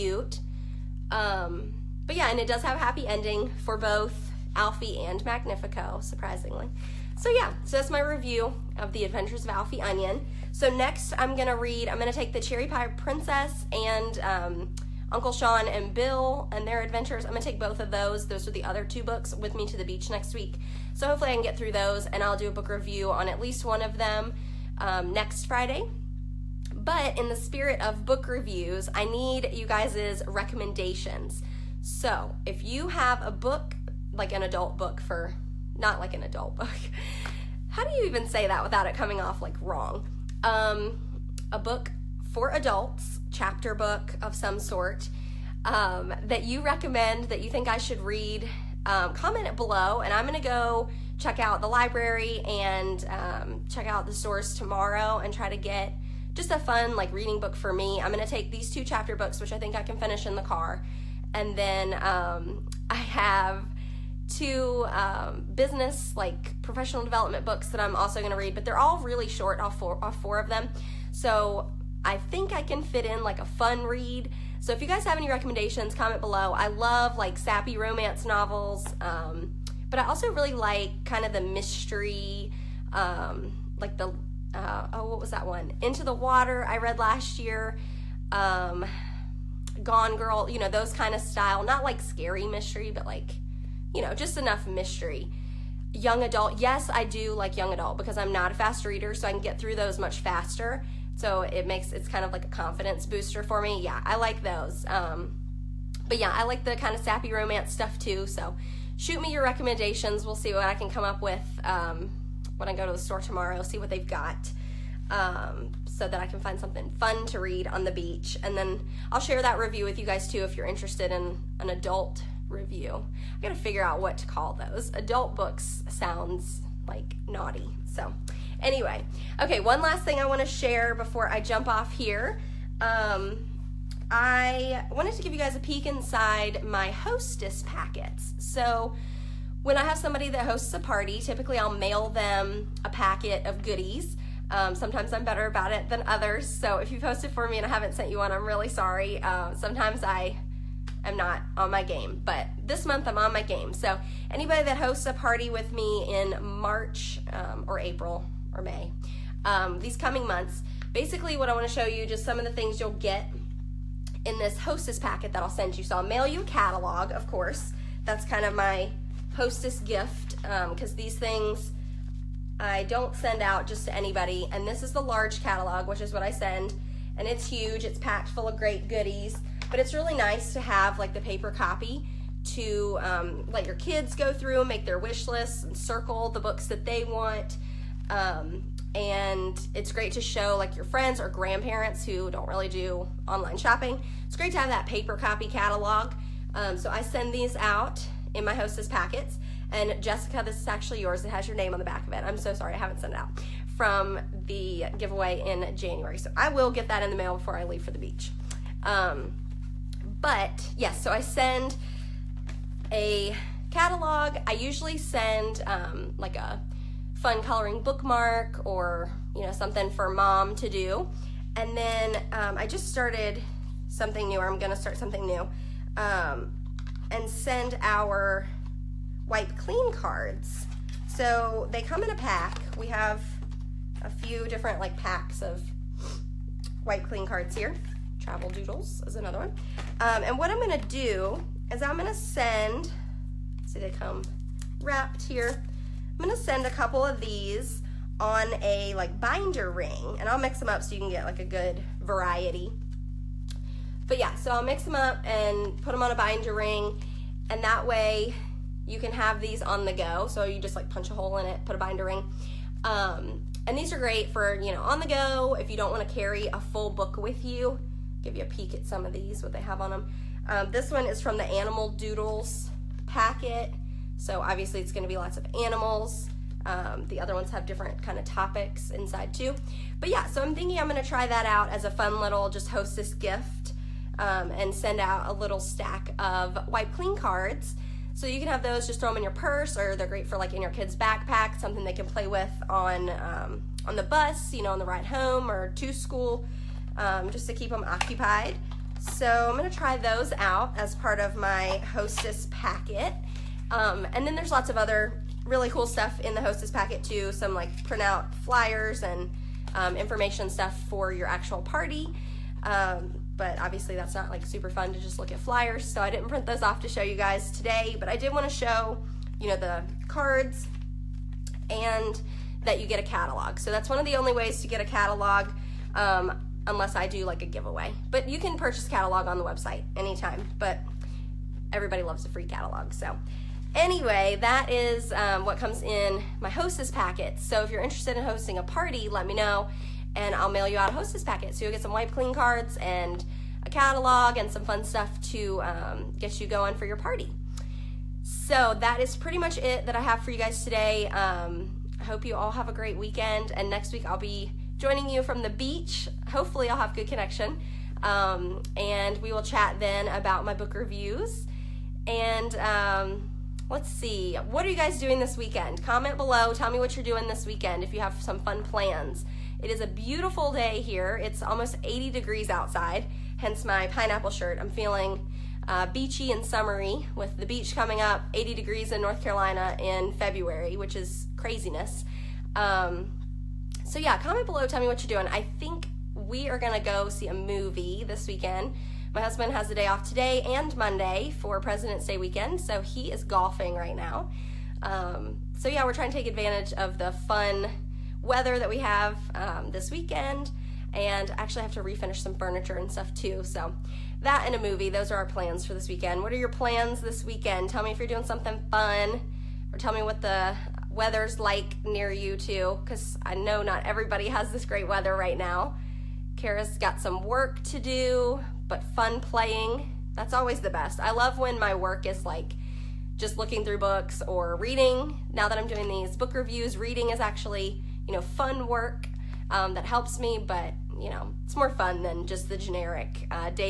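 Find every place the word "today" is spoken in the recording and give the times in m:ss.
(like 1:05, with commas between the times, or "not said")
5:17, 5:50, 6:30.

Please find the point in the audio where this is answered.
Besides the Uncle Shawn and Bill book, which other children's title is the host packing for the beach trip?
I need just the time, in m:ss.
0:12.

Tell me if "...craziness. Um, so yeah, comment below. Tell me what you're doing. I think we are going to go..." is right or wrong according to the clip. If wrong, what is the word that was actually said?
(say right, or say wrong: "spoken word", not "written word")
right.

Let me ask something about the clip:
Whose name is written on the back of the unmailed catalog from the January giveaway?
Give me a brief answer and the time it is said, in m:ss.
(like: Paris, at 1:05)
Jessica, at 3:19.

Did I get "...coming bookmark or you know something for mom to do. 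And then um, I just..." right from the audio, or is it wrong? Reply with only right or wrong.
wrong.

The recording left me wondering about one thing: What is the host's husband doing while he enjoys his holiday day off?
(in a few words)
golfing.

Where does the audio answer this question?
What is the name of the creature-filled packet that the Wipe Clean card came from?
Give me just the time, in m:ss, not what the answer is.
4:31.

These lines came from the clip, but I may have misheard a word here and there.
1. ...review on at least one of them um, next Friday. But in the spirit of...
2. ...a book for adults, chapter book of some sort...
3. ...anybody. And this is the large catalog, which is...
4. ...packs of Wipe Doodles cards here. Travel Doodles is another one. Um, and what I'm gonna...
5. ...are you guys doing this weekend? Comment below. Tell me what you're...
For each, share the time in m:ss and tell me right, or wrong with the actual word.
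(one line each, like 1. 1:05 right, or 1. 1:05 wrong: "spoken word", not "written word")
1. 0:22 right
2. 0:41 right
3. 2:53 right
4. 3:54 wrong: "Clean", not "Doodles"
5. 6:04 right.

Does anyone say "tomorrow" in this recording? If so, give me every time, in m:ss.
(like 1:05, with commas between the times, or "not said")
0:54, 1:53.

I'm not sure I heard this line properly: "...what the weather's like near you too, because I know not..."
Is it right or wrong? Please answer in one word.
right.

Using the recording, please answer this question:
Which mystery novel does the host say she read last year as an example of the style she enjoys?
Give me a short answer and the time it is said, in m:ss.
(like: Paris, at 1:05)
Into the Water, at 1:25.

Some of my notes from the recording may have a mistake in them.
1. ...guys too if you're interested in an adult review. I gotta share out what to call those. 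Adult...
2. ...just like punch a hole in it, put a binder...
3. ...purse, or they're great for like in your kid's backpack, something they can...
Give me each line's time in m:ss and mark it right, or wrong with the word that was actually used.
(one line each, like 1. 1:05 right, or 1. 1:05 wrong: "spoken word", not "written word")
1. 2:00 wrong: "figure", not "share"
2. 4:20 right
3. 4:49 right.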